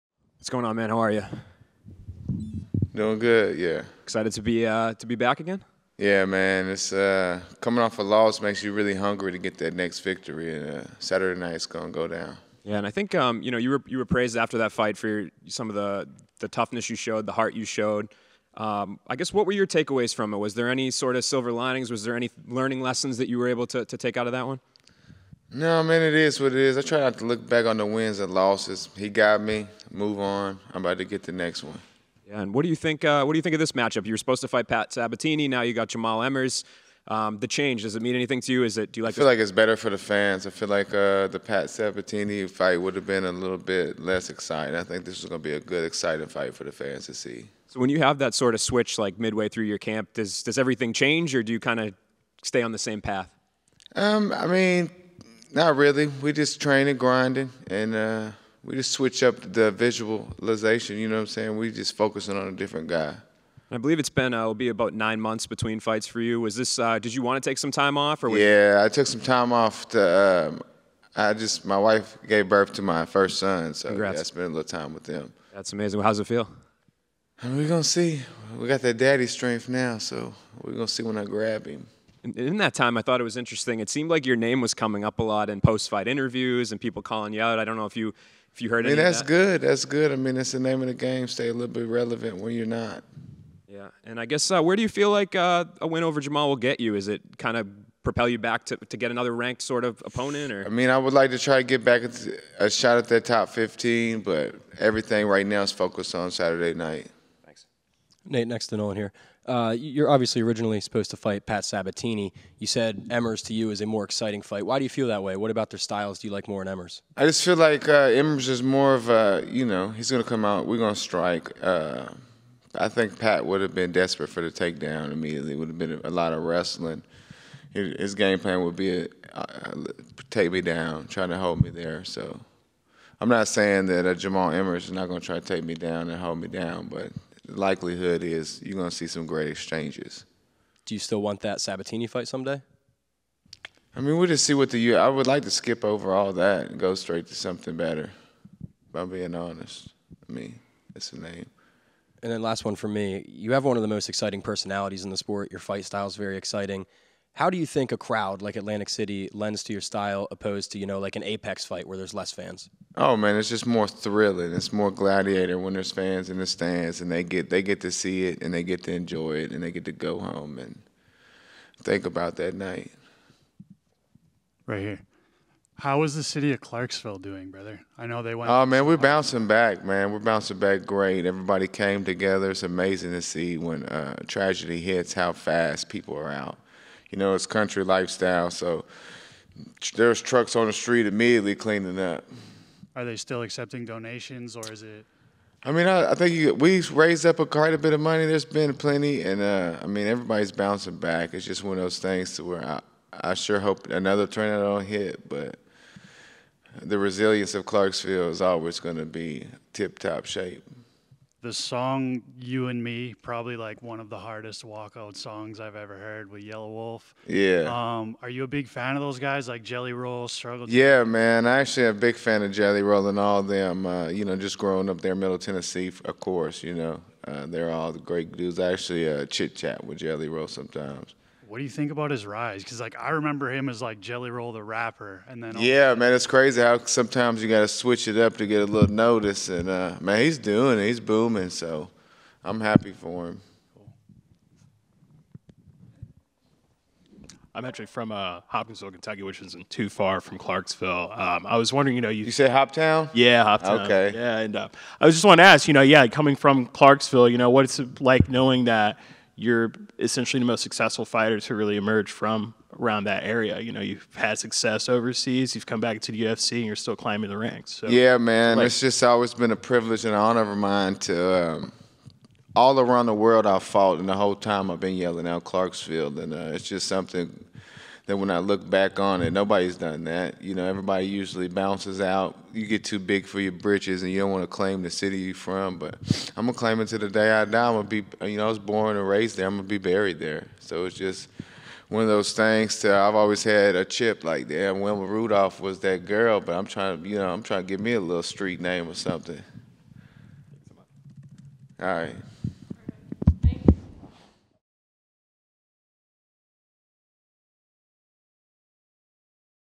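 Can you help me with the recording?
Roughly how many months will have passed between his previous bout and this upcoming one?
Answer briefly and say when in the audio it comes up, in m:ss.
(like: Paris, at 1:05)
9, at 1:04.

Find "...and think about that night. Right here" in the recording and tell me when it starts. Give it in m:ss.
2:50.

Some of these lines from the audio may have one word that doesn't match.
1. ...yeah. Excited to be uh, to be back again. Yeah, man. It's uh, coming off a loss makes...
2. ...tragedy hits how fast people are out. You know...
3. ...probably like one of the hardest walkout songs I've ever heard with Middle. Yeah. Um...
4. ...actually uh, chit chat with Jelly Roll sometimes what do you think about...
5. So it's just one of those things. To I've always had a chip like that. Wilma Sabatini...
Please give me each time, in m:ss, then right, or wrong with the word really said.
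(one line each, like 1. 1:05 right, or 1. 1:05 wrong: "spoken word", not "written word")
1. 0:03 right
2. 3:04 right
3. 3:33 wrong: "Yelawolf", not "Middle"
4. 3:48 right
5. 4:50 wrong: "Rudolph", not "Sabatini".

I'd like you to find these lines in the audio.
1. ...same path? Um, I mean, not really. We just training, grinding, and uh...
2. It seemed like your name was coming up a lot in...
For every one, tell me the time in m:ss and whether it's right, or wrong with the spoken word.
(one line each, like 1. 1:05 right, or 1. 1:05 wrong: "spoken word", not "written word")
1. 0:52 right
2. 1:23 right.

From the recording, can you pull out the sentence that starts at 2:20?
Do you still want that Sabatini fight someday?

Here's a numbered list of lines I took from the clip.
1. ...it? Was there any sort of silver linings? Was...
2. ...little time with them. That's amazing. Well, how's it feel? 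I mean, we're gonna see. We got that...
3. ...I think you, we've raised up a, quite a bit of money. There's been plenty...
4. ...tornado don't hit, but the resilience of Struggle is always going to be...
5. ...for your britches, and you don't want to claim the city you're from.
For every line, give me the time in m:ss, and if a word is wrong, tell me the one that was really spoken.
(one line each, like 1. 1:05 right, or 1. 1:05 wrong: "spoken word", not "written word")
1. 0:20 right
2. 1:14 right
3. 3:16 right
4. 3:24 wrong: "Clarksville", not "Struggle"
5. 4:43 right.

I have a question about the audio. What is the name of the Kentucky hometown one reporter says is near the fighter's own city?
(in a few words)
Hopkinsville.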